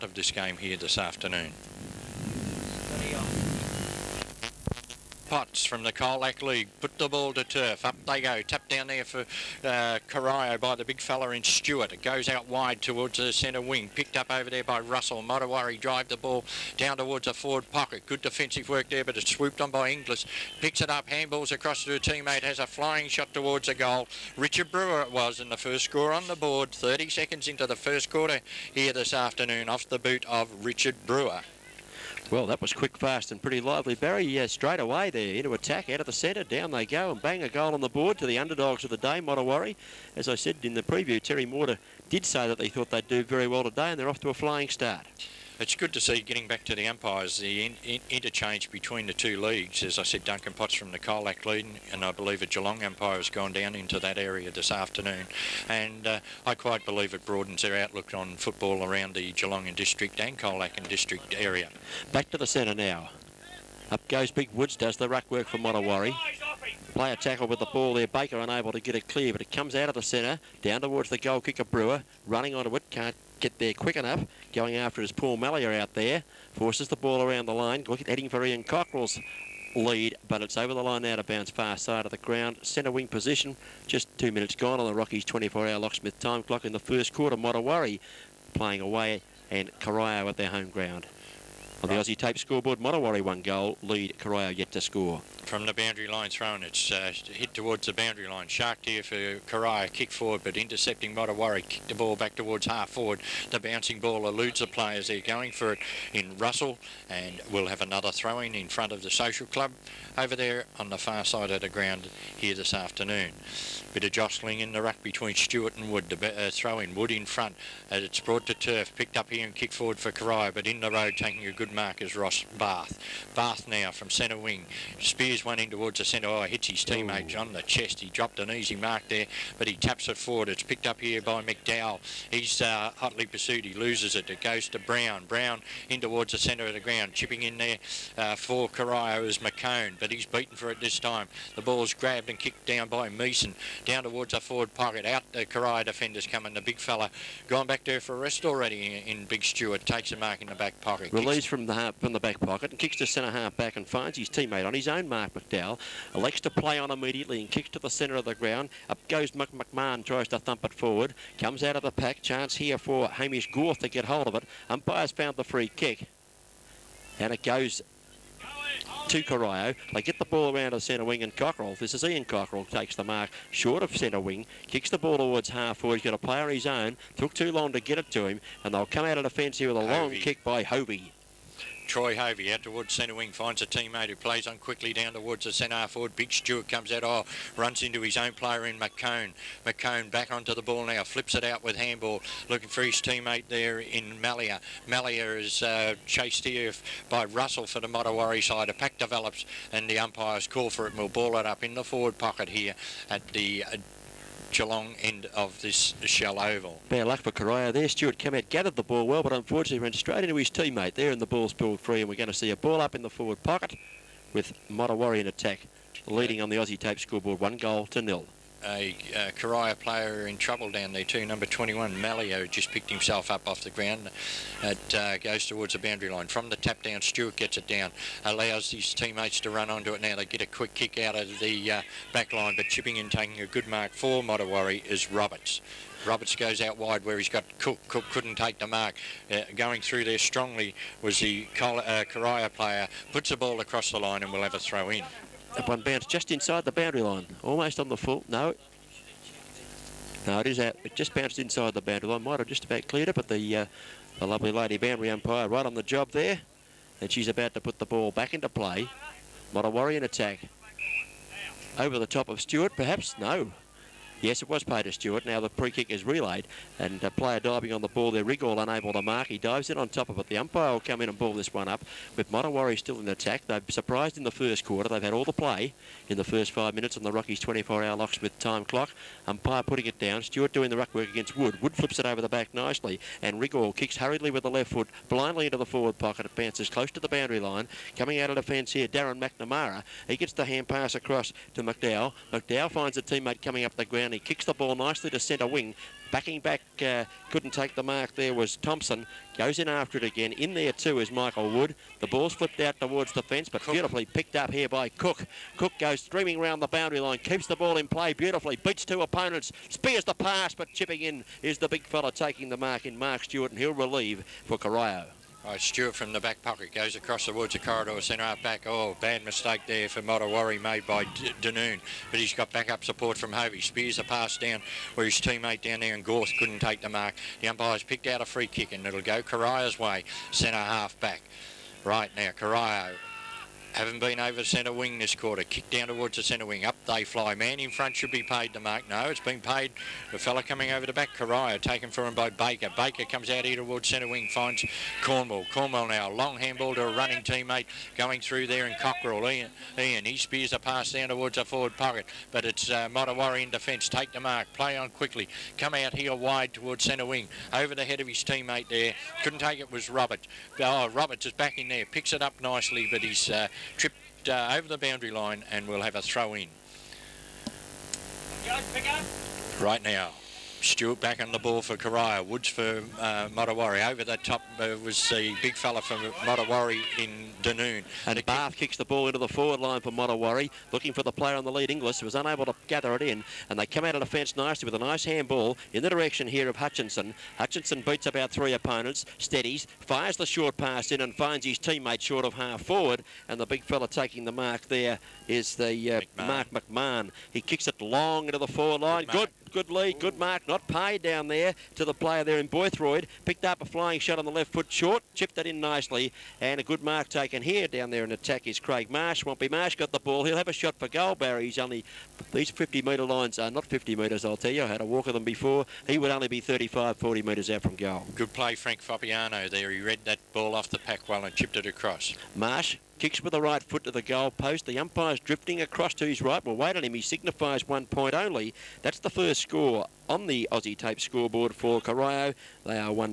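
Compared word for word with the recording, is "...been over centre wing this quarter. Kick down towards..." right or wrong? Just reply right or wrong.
right.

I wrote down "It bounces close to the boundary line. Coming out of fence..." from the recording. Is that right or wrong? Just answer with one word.
wrong.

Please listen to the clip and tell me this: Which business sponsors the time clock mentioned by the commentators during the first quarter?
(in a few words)
Rockies 24-hour locksmith.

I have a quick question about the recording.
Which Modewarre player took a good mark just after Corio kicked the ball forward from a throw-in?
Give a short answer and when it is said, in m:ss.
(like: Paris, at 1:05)
Ross Bath, at 2:02.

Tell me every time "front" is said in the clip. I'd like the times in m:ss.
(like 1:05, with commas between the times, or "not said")
1:48, 1:57, 5:37.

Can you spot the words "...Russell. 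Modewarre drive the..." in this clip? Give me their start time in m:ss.
0:14.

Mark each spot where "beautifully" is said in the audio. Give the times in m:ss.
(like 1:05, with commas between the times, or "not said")
5:03, 5:08.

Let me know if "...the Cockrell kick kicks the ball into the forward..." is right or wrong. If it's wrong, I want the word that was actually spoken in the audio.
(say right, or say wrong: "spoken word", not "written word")
wrong: "Bath", not "Cockrell".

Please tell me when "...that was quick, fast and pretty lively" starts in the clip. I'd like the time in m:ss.
0:32.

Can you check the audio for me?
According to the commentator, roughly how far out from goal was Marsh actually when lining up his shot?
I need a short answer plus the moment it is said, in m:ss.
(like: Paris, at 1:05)
35 to 40 metres, at 6:56.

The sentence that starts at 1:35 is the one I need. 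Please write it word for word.
From the boundary line thrown, it's uh, hit towards the boundary line.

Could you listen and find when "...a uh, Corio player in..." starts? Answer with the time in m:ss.
3:38.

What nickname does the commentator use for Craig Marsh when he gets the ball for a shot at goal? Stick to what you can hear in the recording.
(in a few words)
Swampy.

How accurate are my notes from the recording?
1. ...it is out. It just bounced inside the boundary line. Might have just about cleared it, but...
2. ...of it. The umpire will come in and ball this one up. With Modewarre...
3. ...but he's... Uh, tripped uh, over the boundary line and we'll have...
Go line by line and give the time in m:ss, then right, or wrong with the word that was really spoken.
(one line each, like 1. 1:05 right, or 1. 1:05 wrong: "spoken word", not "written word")
1. 4:10 right
2. 4:30 right
3. 6:02 right.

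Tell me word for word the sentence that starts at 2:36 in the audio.
Elects to play on immediately and kicks to the centre of the ground.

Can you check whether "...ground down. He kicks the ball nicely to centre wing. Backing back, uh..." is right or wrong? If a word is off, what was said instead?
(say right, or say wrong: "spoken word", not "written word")
right.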